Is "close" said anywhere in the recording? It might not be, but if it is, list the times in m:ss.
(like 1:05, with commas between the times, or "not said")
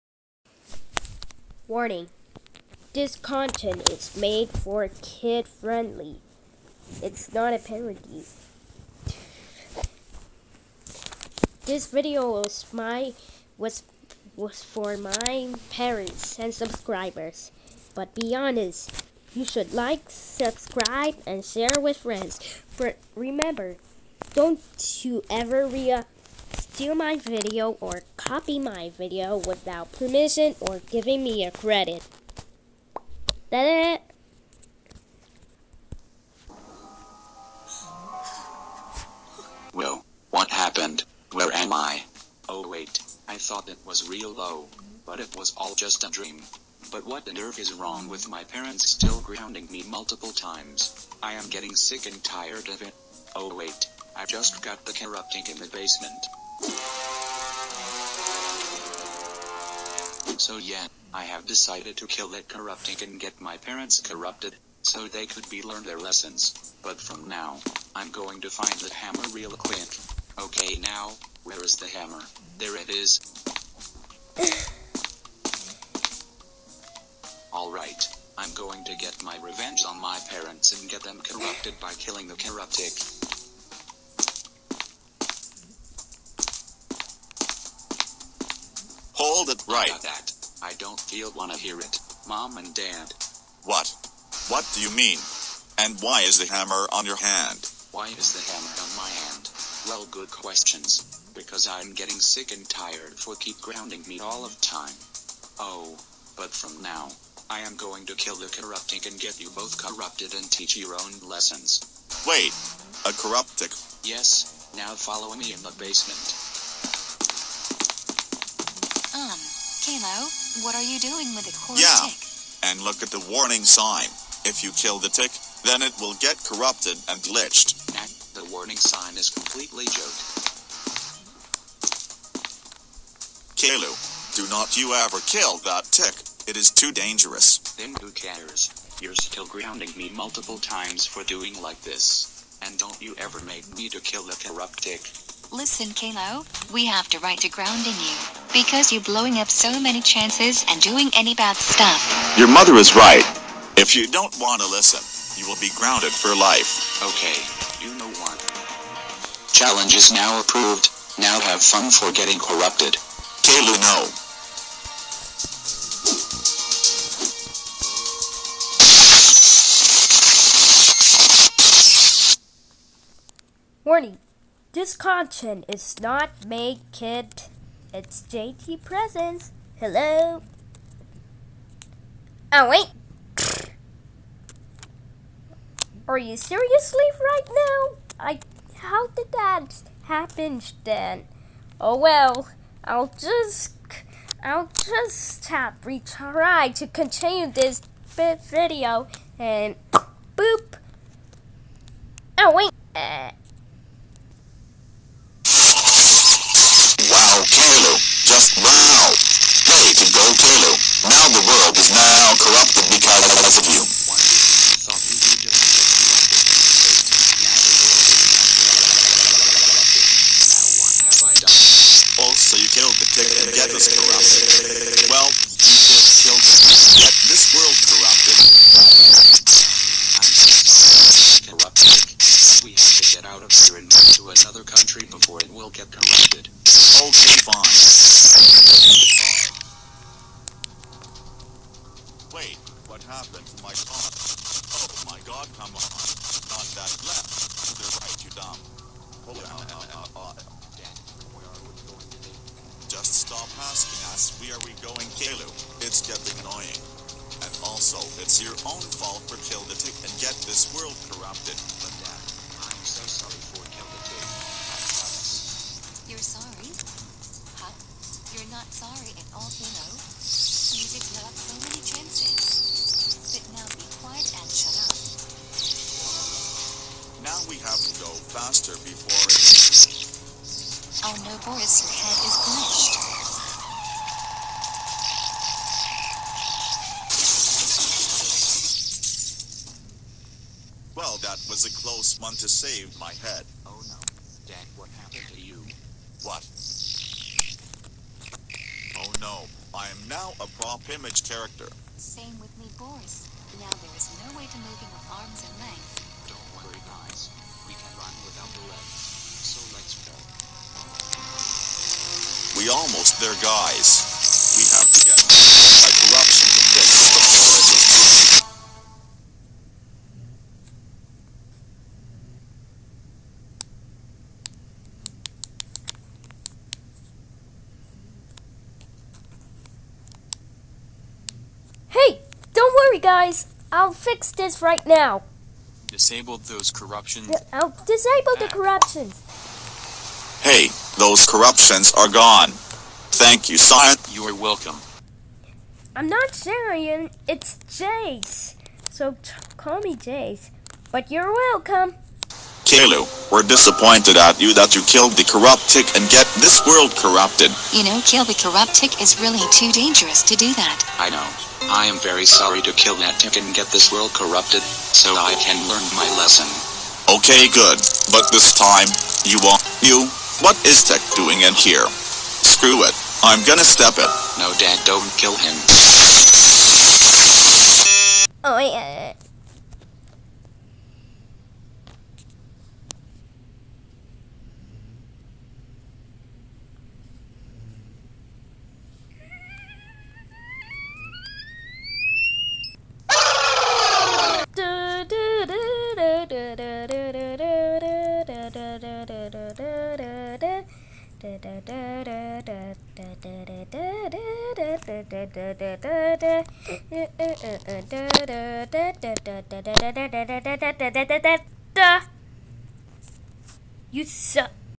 4:51.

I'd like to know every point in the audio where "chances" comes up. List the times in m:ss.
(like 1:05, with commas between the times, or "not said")
2:30, 4:31.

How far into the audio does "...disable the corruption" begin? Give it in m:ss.
5:37.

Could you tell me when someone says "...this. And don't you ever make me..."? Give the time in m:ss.
2:21.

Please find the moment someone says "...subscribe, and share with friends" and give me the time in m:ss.
0:20.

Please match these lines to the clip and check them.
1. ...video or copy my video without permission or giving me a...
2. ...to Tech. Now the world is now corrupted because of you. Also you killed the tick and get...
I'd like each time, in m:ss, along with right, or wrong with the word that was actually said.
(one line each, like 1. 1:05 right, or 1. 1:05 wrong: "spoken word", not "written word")
1. 0:27 right
2. 3:29 wrong: "Goltelu", not "Tech".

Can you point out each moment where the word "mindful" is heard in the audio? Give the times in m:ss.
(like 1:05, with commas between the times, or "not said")
not said.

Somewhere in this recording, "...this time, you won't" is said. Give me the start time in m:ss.
6:08.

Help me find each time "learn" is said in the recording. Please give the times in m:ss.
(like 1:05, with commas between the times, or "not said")
1:05, 6:05.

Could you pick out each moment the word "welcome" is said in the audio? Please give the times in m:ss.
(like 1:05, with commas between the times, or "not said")
5:44, 5:51.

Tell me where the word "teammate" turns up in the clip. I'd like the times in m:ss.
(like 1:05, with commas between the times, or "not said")
not said.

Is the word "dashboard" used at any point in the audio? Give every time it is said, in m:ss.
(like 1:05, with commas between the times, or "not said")
not said.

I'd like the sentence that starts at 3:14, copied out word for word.
I'll just tap retry to continue this video and boop.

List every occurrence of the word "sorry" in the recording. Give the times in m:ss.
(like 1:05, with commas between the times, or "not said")
4:28, 6:02.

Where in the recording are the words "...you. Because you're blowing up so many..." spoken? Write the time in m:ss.
2:27.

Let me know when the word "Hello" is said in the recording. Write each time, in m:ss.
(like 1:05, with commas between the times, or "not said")
2:59.